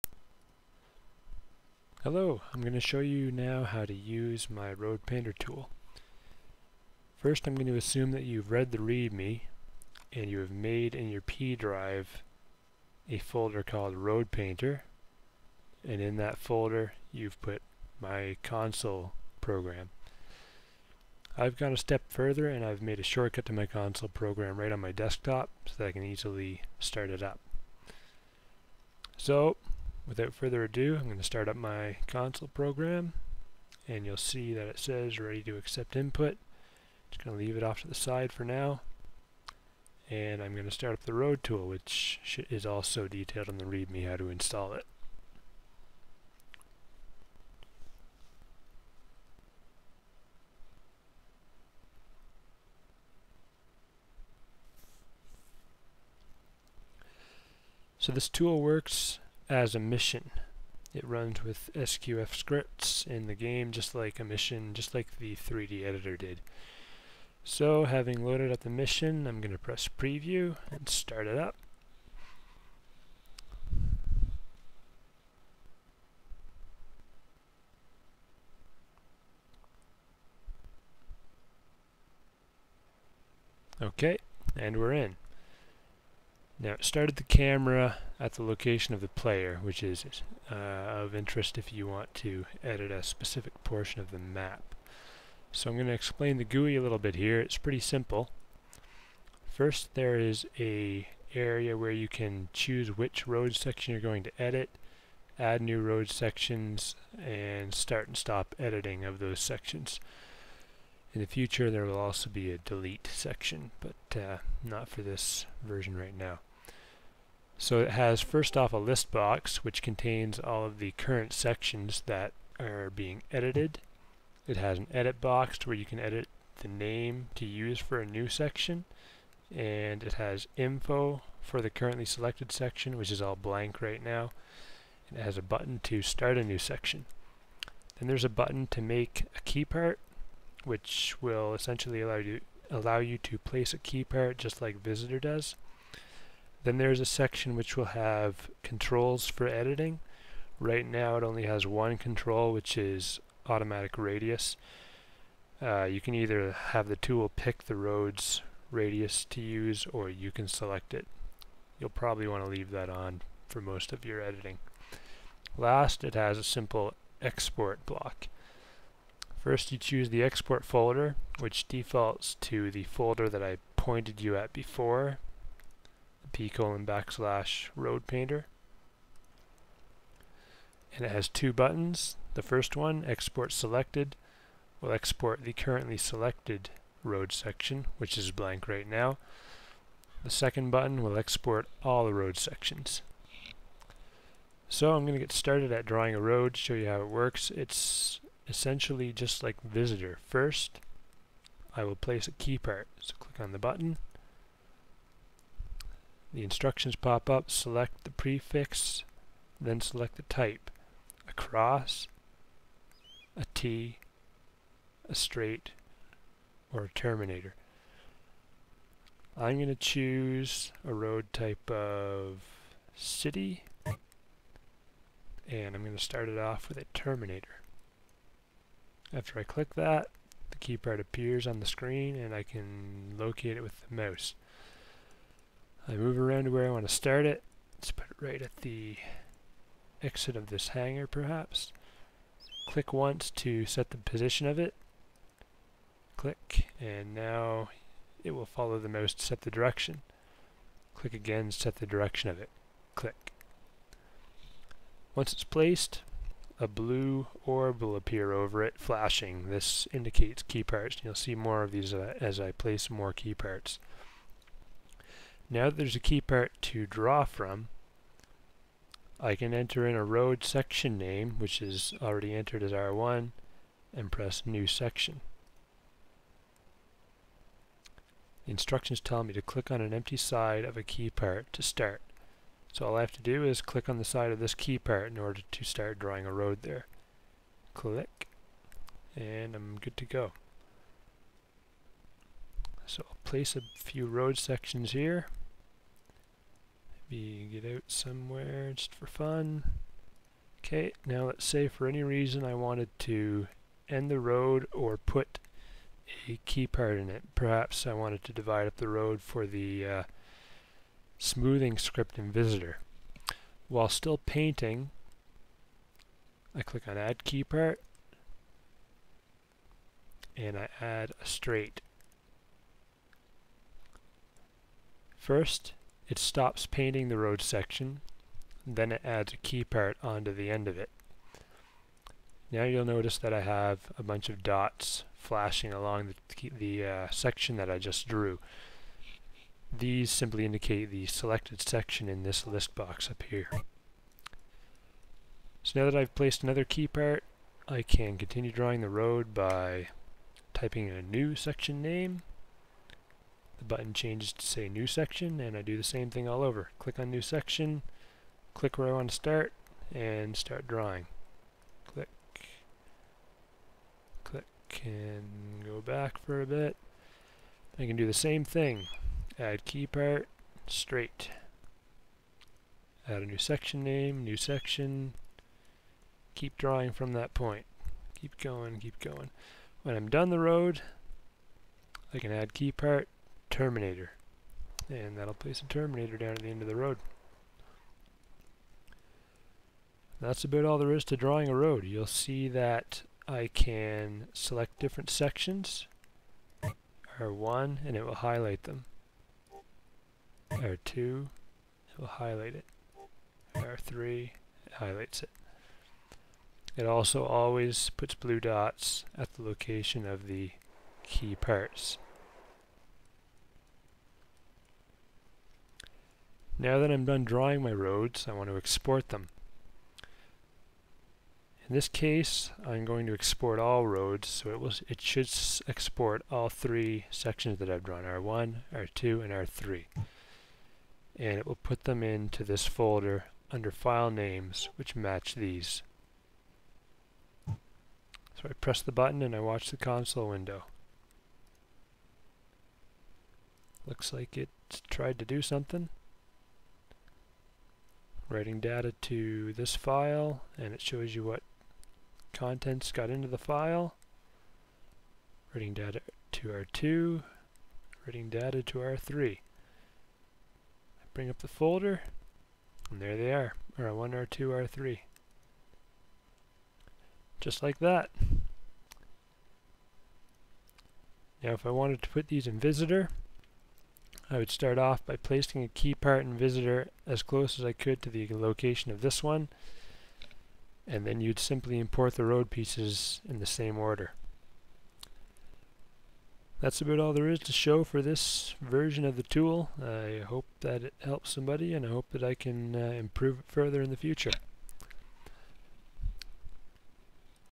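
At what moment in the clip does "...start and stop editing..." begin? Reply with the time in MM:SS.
01:47.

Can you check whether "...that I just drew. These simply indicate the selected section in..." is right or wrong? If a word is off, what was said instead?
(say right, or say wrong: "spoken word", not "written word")
right.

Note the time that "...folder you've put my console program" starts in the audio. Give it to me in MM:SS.
00:16.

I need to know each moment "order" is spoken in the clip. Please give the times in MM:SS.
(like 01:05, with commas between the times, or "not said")
04:45, 08:03.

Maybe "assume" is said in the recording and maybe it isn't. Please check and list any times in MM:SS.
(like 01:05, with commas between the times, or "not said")
00:07.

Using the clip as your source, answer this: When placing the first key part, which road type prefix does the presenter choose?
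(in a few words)
city.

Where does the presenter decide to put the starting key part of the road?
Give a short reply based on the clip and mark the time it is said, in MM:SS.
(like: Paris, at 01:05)
exit of this hangar, at 04:00.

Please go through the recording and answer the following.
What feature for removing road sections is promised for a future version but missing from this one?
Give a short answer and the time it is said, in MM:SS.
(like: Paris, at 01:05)
delete section, at 01:52.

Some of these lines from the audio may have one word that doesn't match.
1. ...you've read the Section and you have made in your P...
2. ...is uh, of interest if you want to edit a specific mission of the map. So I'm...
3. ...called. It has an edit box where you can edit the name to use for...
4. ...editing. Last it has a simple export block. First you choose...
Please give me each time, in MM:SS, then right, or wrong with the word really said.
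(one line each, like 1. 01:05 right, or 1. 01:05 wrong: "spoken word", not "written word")
1. 00:08 wrong: "README", not "Section"
2. 01:29 wrong: "portion", not "mission"
3. 02:03 wrong: "edited", not "called"
4. 02:44 right.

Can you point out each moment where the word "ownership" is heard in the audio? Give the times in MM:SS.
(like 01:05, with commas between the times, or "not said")
not said.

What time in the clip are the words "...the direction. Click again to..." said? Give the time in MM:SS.
04:09.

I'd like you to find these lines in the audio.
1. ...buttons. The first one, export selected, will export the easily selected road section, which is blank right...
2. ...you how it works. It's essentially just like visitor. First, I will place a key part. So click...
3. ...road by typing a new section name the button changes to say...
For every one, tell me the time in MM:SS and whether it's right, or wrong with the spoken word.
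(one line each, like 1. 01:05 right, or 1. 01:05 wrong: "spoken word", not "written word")
1. 03:01 wrong: "currently", not "easily"
2. 03:16 right
3. 05:48 right.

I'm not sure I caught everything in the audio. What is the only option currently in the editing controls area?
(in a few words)
automatic radius.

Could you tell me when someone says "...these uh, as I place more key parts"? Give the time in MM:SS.
04:21.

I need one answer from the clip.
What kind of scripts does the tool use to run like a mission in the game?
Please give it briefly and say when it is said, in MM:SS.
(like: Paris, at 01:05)
SQF, at 01:01.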